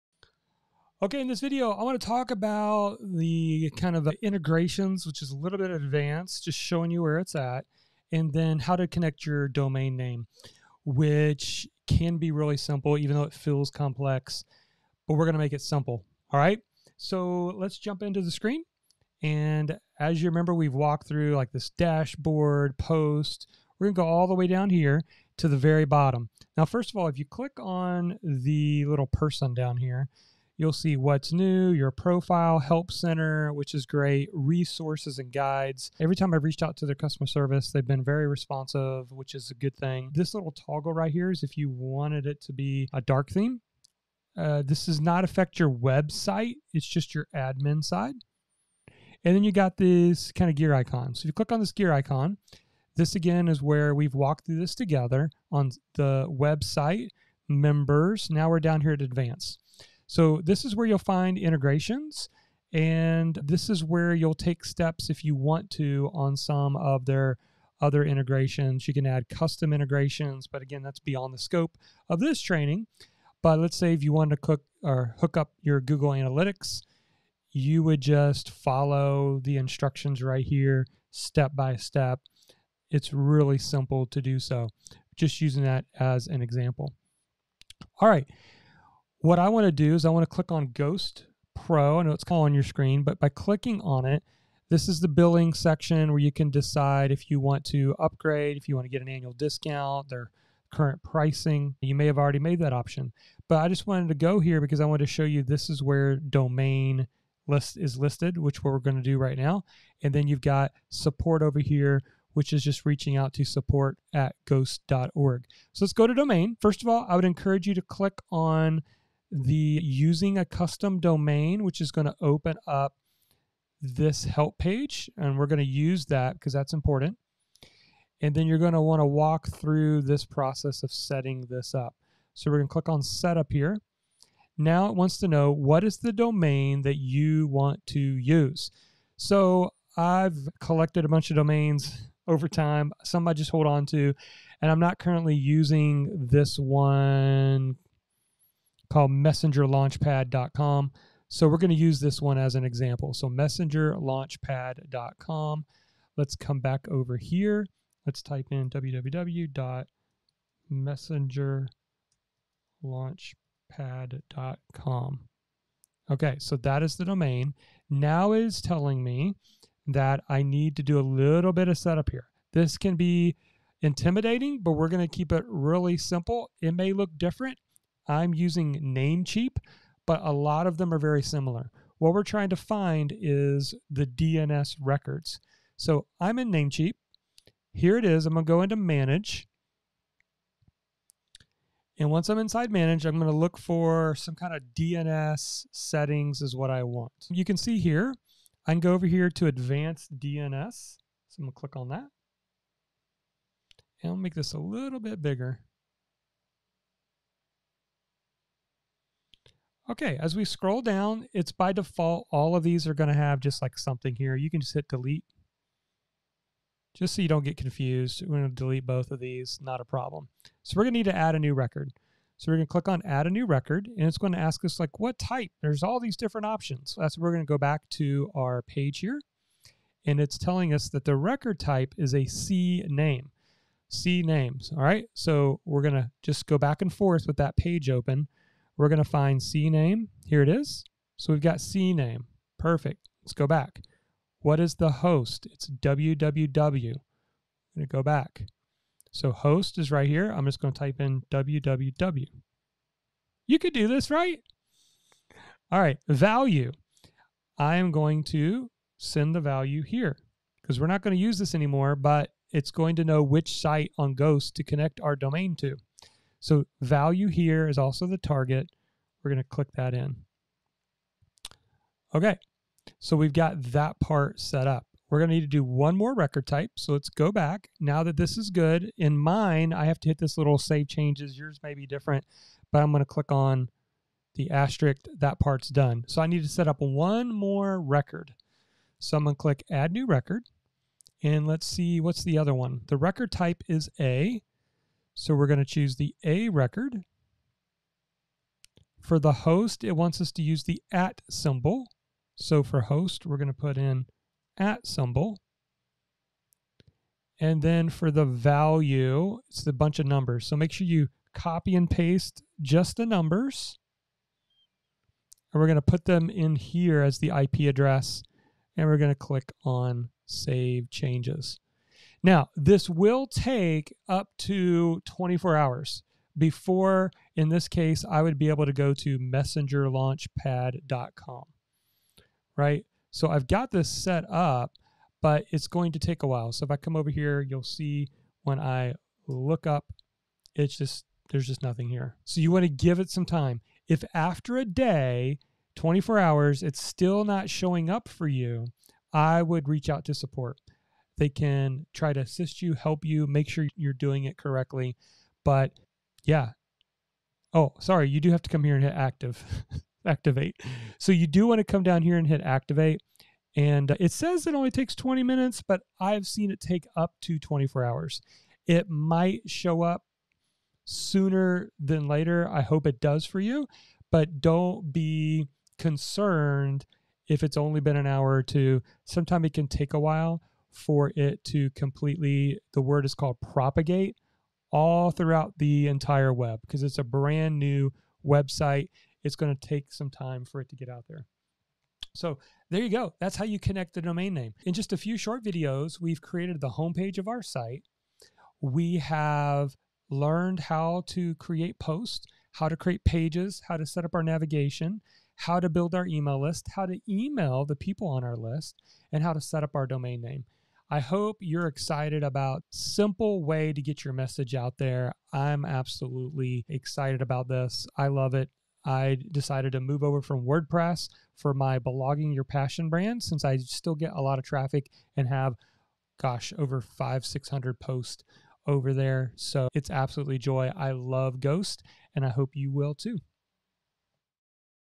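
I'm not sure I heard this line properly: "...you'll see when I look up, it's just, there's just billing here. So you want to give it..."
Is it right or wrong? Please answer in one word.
wrong.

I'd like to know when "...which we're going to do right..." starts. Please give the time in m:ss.
1:48.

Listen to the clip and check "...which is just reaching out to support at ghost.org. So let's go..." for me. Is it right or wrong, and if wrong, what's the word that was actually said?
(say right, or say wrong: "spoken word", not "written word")
right.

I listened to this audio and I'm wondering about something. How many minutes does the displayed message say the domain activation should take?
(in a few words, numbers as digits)
20 minutes.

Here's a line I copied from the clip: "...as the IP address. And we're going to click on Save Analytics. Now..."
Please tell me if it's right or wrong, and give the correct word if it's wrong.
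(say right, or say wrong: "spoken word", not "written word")
wrong: "Changes", not "Analytics".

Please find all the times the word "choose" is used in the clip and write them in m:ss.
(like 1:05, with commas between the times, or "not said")
4:55.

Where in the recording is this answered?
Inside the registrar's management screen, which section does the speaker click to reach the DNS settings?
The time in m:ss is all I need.
3:19.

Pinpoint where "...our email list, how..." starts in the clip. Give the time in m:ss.
6:45.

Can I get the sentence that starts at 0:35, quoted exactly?
Every time I've reached out to their customer service, they've been very responsive, which is a good thing.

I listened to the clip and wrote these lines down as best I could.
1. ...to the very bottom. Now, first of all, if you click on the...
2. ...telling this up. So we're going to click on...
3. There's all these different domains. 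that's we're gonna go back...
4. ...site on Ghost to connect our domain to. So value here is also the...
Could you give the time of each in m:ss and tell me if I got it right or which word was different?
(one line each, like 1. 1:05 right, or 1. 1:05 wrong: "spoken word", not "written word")
1. 0:25 right
2. 2:10 wrong: "setting", not "telling"
3. 3:45 wrong: "options", not "domains"
4. 4:23 right.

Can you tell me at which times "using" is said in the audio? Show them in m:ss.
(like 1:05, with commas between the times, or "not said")
1:25, 1:59, 2:25, 2:58.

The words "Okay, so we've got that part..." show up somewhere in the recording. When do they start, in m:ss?
4:32.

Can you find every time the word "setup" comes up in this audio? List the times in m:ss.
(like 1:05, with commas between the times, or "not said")
2:13, 2:51.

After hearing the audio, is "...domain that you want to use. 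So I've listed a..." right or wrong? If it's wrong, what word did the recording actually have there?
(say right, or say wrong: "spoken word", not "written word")
wrong: "collected", not "listed".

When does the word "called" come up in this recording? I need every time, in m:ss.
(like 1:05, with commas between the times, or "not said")
2:28, 6:23.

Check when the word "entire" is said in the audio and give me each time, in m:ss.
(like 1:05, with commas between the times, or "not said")
6:25.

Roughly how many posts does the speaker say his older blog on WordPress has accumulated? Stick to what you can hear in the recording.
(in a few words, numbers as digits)
5,600.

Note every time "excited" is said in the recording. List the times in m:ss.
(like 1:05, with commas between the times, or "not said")
6:51, 6:56.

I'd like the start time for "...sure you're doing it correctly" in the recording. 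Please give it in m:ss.
5:53.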